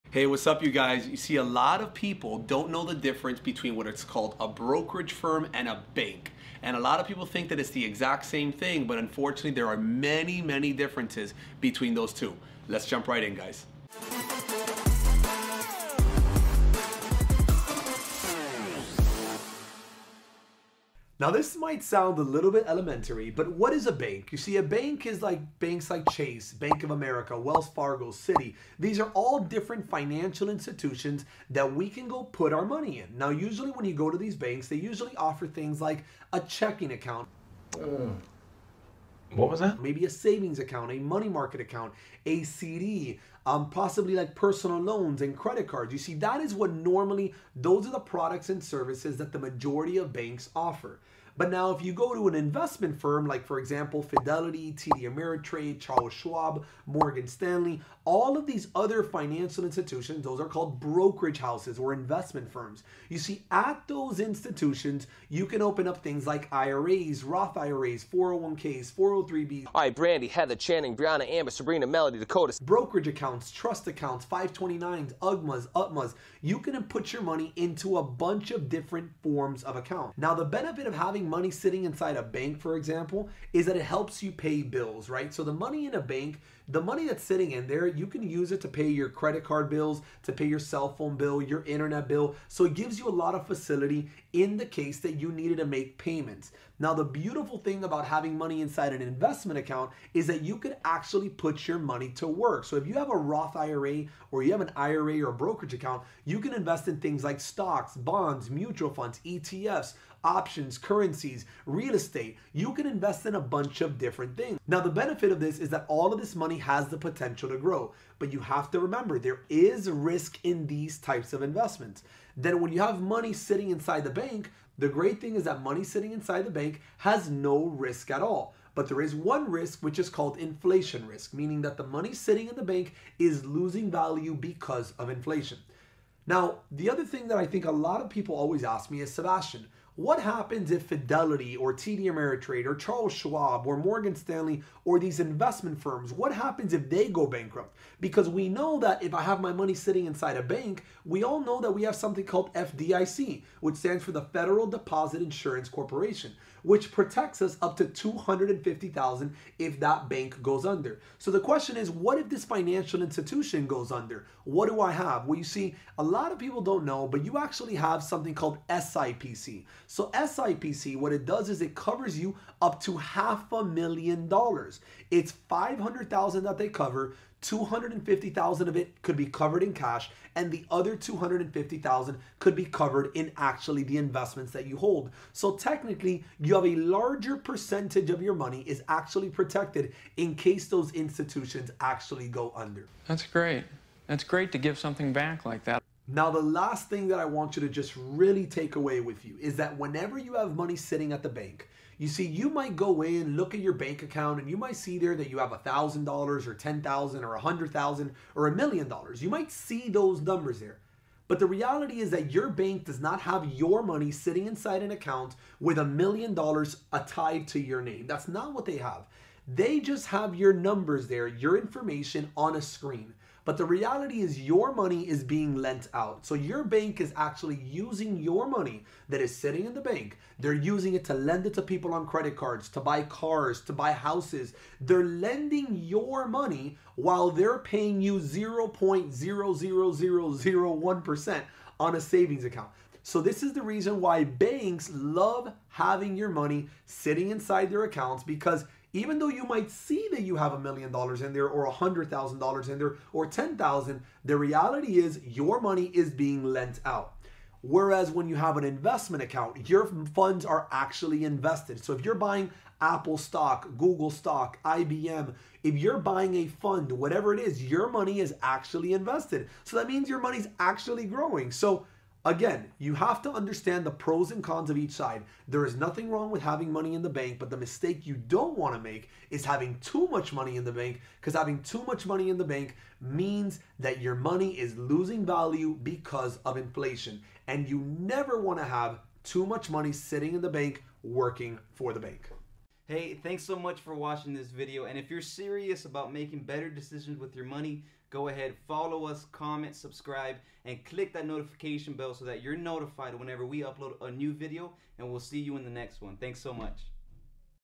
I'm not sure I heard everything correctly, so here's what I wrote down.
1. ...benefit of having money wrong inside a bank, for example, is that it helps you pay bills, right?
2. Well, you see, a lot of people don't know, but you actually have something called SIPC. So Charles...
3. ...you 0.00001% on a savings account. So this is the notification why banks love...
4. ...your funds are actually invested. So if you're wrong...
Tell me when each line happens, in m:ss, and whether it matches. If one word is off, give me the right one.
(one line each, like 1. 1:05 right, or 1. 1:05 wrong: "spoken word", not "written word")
1. 1:20 wrong: "sitting", not "wrong"
2. 2:45 wrong: "SIPC", not "Charles"
3. 3:57 wrong: "reason", not "notification"
4. 4:19 wrong: "buying", not "wrong".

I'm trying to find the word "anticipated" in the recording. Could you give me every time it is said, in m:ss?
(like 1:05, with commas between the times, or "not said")
not said.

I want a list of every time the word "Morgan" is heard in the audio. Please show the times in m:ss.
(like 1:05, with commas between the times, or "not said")
0:56, 2:23.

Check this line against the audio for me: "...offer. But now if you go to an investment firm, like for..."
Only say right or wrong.
right.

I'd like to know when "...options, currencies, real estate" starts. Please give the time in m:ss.
1:50.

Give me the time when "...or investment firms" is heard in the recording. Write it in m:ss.
1:01.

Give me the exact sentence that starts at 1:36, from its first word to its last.
Now, the beautiful thing about having money inside an investment account is that you could actually put your money to work.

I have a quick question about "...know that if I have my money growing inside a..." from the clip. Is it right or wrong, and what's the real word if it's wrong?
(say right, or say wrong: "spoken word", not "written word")
wrong: "sitting", not "growing".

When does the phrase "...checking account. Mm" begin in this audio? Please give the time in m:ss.
0:36.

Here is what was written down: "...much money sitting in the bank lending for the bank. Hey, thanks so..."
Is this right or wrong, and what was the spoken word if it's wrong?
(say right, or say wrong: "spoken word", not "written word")
wrong: "working", not "lending".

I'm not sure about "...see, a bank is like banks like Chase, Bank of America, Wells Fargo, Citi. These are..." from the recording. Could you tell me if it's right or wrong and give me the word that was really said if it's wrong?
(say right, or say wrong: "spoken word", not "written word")
right.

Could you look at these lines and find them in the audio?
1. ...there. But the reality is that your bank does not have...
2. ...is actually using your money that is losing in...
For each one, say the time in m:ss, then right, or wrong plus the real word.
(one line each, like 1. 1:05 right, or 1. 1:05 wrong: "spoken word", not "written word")
1. 3:30 right
2. 3:47 wrong: "sitting", not "losing".